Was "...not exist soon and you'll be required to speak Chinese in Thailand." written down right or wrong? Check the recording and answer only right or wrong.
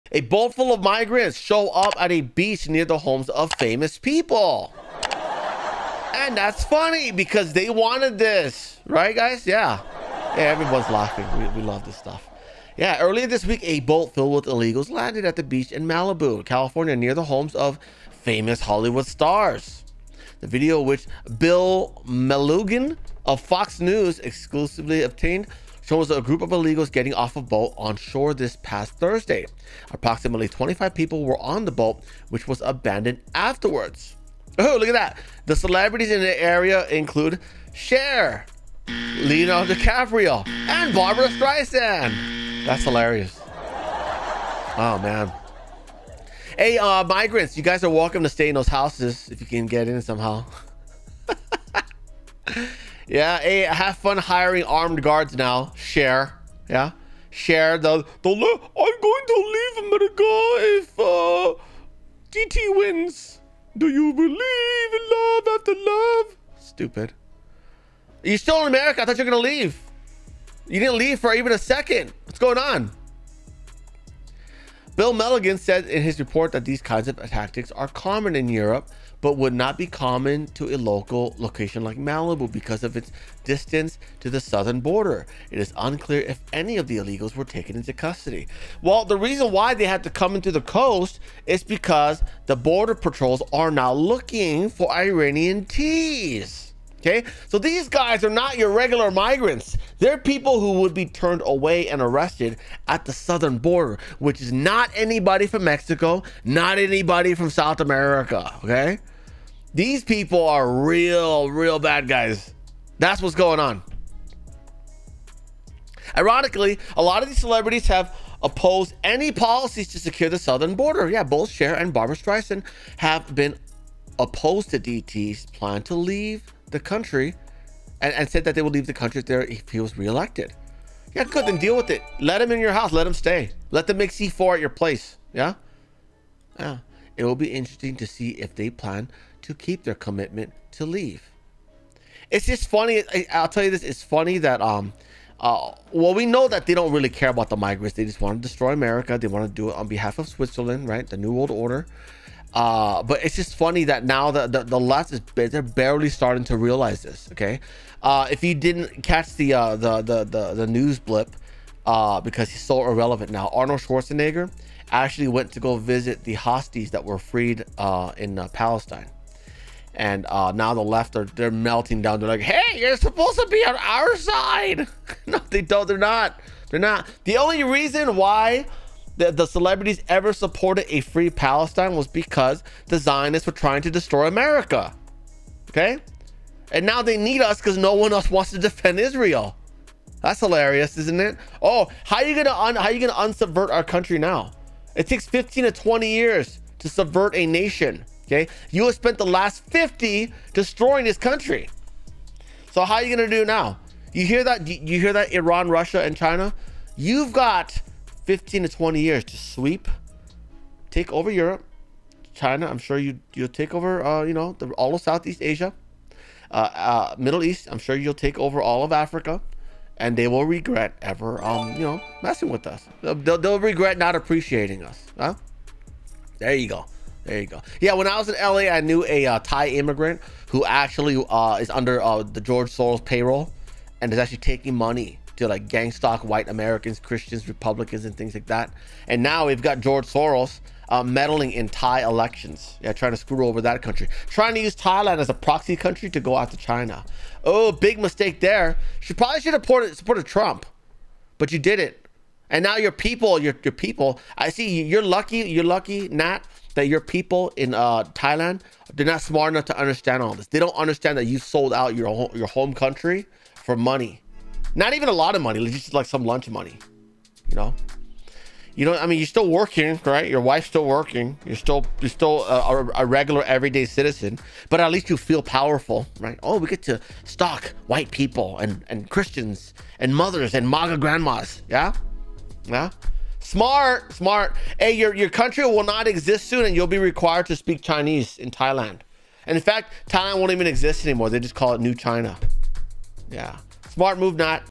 right.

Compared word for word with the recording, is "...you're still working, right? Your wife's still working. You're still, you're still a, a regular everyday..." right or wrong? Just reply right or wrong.
right.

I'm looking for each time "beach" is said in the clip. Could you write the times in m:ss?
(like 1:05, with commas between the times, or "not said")
0:02, 0:15.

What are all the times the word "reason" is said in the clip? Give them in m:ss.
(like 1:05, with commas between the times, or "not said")
1:29, 2:57.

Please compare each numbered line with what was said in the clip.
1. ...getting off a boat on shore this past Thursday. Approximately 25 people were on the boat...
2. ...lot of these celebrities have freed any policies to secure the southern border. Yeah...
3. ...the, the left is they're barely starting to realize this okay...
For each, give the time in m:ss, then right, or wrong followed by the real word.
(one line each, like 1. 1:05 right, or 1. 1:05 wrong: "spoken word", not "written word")
1. 0:26 right
2. 1:57 wrong: "opposed", not "freed"
3. 2:34 right.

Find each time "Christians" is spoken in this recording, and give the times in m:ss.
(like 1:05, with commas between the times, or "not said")
3:56, 4:39.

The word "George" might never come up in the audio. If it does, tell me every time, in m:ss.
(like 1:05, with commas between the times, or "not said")
3:52, 3:59.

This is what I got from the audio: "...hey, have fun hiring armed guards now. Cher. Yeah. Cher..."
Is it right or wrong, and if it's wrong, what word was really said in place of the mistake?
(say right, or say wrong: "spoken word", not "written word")
right.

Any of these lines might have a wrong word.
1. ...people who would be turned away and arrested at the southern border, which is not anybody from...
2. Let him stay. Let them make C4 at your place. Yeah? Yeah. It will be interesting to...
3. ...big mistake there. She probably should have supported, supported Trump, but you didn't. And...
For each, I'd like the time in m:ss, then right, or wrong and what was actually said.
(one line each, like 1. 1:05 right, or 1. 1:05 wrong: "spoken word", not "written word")
1. 1:40 right
2. 2:12 right
3. 4:07 right.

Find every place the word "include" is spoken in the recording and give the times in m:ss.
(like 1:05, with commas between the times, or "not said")
0:36.